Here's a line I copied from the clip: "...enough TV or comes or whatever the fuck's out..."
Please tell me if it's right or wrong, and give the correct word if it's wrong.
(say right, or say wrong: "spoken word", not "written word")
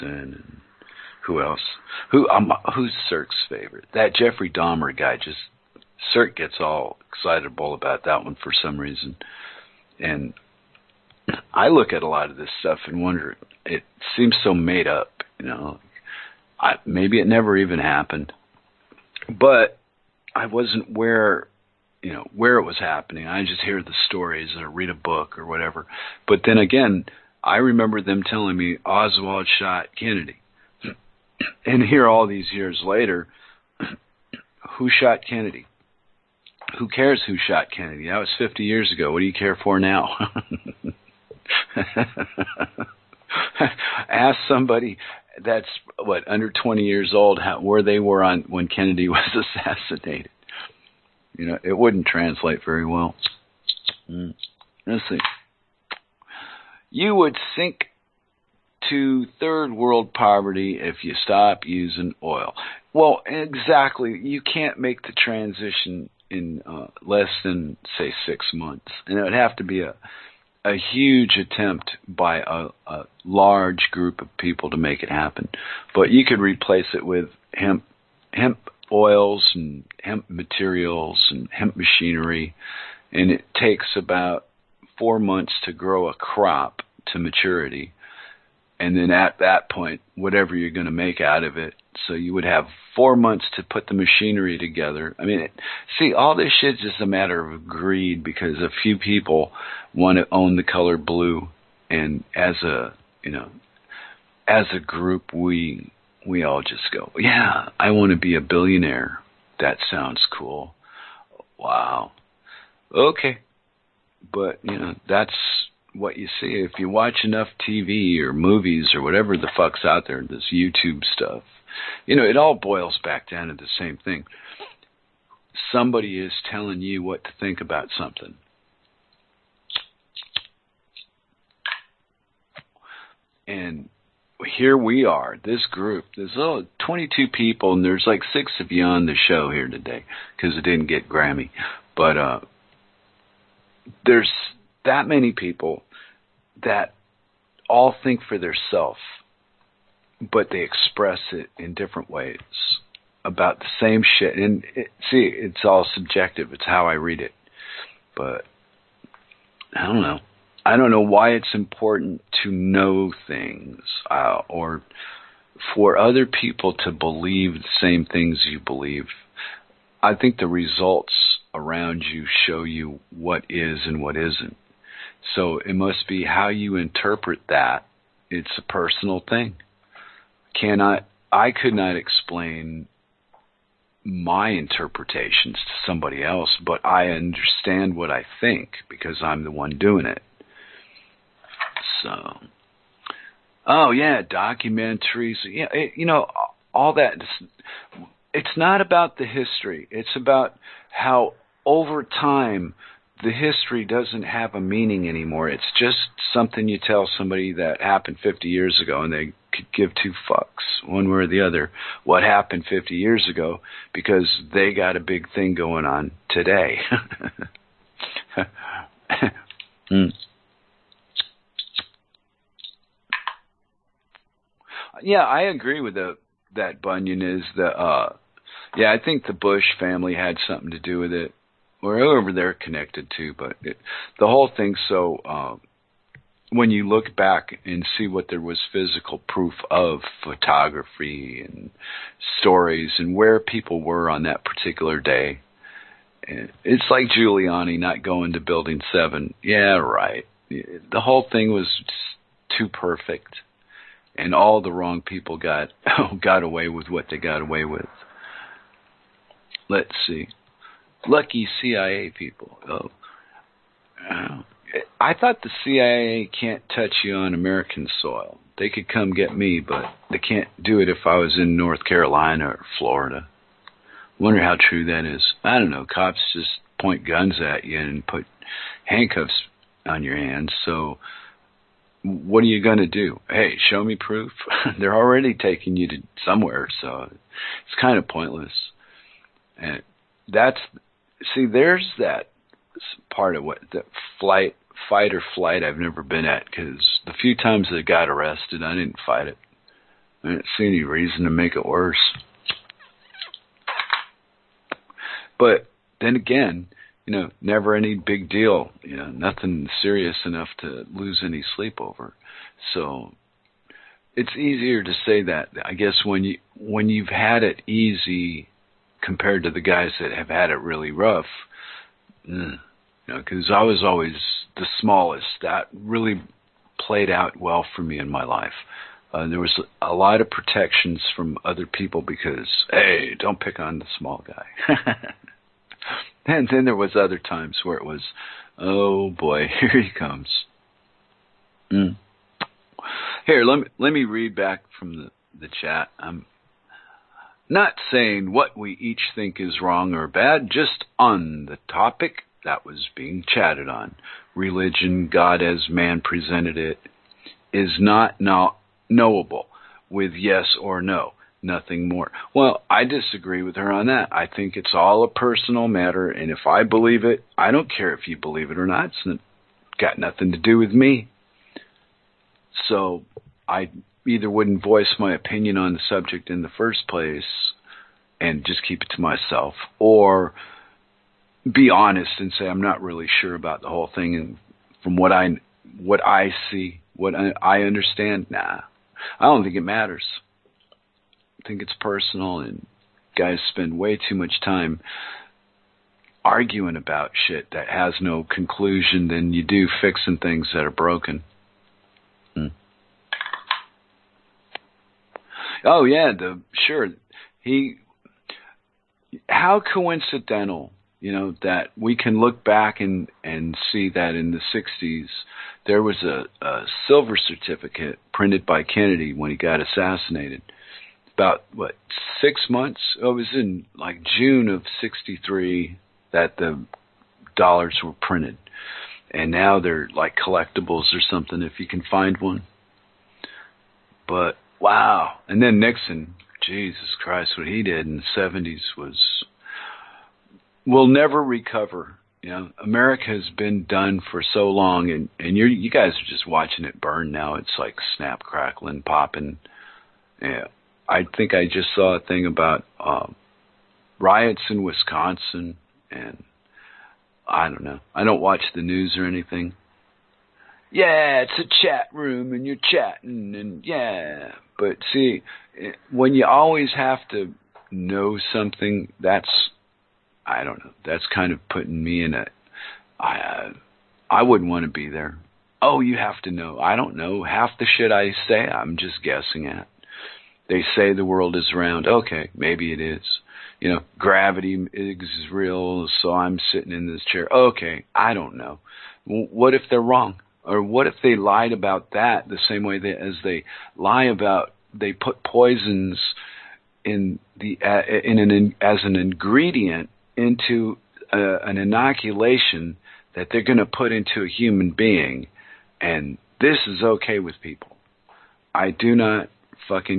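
wrong: "movies", not "comes".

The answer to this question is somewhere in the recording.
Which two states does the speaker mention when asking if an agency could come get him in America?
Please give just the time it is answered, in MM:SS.
04:31.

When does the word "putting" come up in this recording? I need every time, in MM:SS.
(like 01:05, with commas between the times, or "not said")
07:51.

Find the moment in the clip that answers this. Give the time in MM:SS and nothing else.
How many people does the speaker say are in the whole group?
02:16.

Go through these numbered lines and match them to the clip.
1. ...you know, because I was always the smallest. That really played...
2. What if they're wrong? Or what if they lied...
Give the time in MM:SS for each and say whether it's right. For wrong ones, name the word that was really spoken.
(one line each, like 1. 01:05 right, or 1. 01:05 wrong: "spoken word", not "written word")
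1. 05:23 right
2. 08:09 right.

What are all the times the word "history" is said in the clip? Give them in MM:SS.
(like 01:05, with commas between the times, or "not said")
03:19, 03:23.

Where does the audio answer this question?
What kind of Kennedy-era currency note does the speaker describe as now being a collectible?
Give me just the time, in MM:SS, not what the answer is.
06:56.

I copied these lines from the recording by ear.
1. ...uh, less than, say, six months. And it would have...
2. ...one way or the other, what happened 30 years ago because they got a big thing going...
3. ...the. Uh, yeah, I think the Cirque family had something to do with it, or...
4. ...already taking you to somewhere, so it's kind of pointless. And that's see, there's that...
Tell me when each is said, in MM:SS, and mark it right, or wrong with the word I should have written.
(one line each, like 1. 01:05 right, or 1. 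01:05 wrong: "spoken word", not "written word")
1. 01:06 right
2. 03:30 wrong: "50", not "30"
3. 03:47 wrong: "Bush", not "Cirque"
4. 04:44 right.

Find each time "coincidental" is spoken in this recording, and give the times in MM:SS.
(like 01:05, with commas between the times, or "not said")
06:49.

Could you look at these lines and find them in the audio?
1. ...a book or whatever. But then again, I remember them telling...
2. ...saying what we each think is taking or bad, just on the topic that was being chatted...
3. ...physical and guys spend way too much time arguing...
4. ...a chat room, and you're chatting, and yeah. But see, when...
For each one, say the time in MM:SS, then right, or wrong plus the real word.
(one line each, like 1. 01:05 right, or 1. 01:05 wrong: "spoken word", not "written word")
1. 00:24 right
2. 05:47 wrong: "wrong", not "taking"
3. 06:31 wrong: "personal", not "physical"
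4. 07:41 right.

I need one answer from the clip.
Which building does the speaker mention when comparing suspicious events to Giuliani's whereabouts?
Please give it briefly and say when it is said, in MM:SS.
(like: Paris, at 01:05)
Building Seven, at 04:08.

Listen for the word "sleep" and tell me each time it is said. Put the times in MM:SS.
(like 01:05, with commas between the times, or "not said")
05:11.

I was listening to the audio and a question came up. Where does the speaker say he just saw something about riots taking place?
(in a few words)
Wisconsin.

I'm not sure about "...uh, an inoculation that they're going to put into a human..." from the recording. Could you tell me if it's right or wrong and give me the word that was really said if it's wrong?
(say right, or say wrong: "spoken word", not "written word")
right.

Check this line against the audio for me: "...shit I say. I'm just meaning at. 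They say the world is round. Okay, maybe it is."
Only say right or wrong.
wrong.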